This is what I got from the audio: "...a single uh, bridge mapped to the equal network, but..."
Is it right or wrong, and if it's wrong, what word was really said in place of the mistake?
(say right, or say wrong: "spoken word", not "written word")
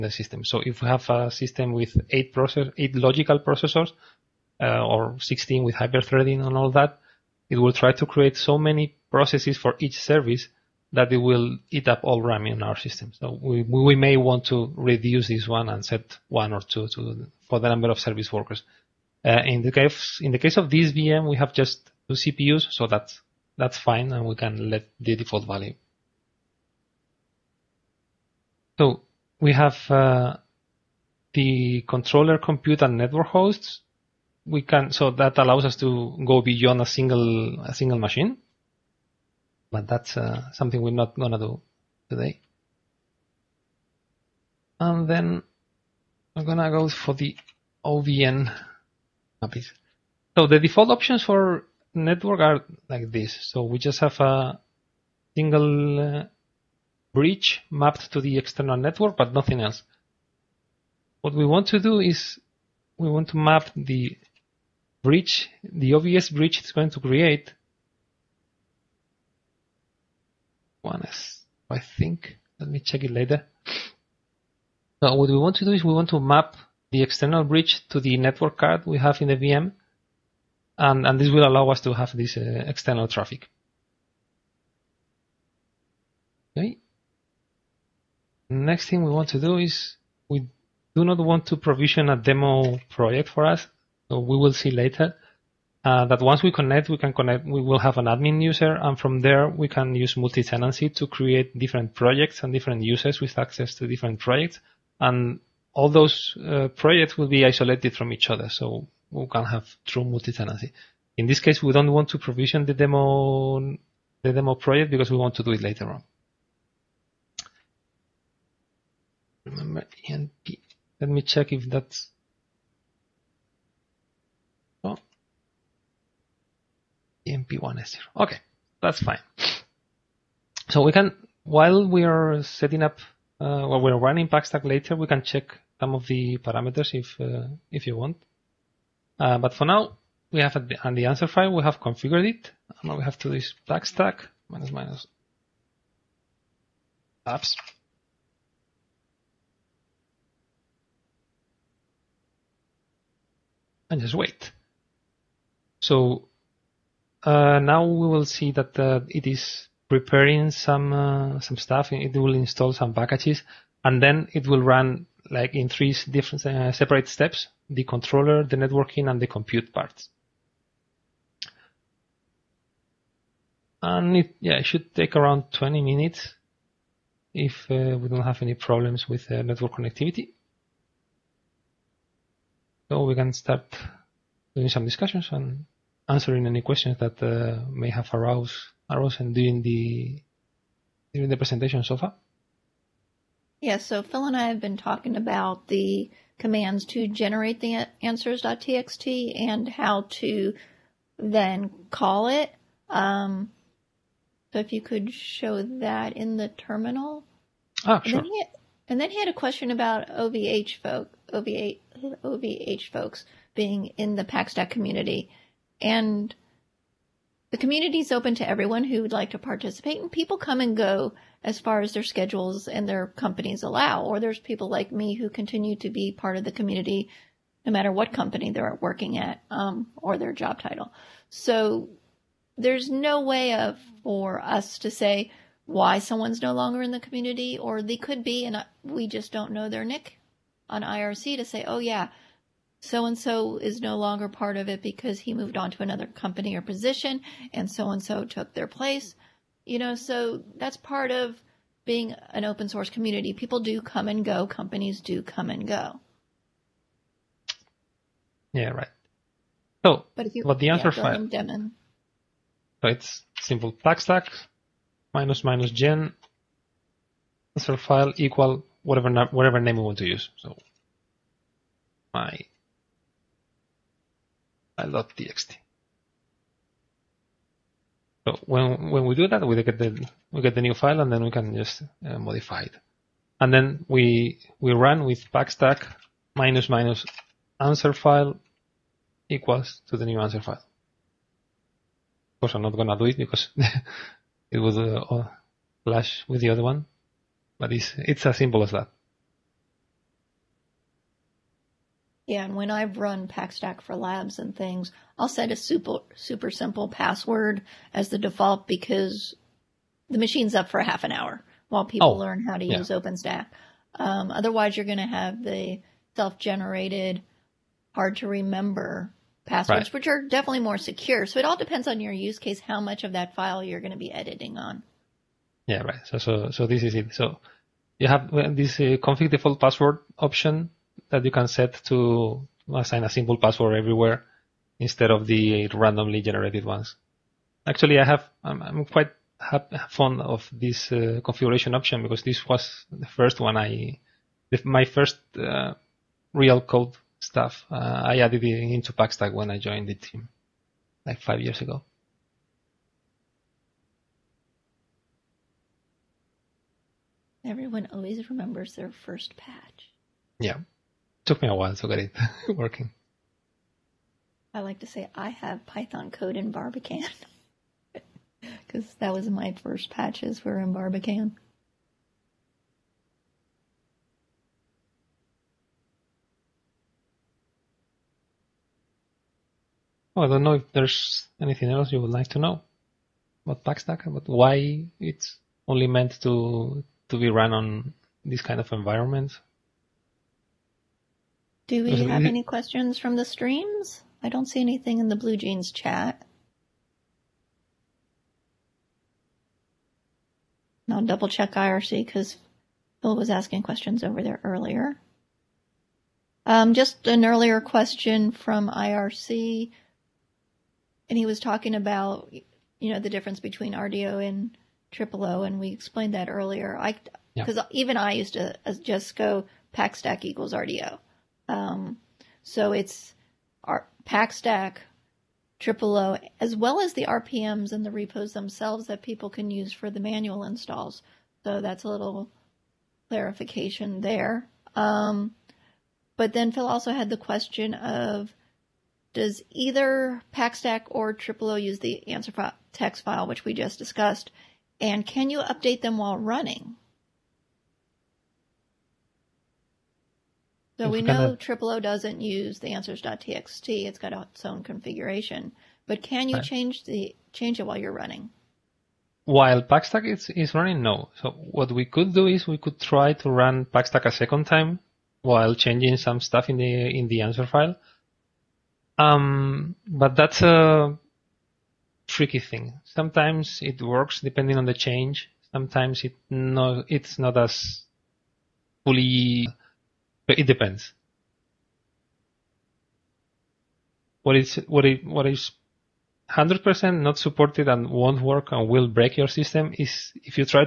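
wrong: "external", not "equal".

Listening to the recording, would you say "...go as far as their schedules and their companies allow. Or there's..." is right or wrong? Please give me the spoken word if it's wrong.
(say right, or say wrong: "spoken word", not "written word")
right.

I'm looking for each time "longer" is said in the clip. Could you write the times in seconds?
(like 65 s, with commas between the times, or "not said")
236 s, 243 s.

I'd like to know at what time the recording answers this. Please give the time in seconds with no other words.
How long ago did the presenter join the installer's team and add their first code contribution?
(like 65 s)
351 s.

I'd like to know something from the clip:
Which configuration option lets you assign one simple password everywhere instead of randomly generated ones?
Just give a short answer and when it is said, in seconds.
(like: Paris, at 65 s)
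config default password, at 328 s.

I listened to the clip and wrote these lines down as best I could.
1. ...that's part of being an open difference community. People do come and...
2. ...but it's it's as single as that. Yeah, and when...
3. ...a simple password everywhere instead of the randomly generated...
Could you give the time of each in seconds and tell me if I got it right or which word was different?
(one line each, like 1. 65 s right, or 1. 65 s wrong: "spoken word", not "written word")
1. 250 s wrong: "source", not "difference"
2. 297 s wrong: "simple", not "single"
3. 333 s right.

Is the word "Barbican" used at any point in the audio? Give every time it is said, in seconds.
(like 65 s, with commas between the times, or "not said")
366 s, 370 s.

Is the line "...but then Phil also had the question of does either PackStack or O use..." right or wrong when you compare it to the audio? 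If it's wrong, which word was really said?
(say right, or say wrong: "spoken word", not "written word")
right.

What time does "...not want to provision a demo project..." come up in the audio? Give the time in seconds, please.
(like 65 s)
91 s.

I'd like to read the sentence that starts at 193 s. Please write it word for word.
Yeah, so Phil and I have been talking about the commands to generate the answers.txt and how to then call it.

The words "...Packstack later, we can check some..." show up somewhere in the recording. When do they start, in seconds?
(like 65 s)
134 s.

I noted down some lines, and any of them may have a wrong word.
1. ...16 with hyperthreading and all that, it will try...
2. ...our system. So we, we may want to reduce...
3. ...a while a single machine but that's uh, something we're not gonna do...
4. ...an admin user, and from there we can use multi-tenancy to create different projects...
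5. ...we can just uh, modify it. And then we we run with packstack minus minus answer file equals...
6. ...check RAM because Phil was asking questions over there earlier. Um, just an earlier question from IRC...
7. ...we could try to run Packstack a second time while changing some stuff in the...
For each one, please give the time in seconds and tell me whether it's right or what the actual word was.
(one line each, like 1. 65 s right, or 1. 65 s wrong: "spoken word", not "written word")
1. 5 s right
2. 12 s right
3. 36 s wrong: "single", not "while"
4. 97 s right
5. 281 s right
6. 401 s wrong: "IRC", not "RAM"
7. 462 s right.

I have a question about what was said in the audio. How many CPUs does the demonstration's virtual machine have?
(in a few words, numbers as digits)
2.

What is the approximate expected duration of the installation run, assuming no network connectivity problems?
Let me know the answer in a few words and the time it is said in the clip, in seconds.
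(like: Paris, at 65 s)
20 minutes, at 175 s.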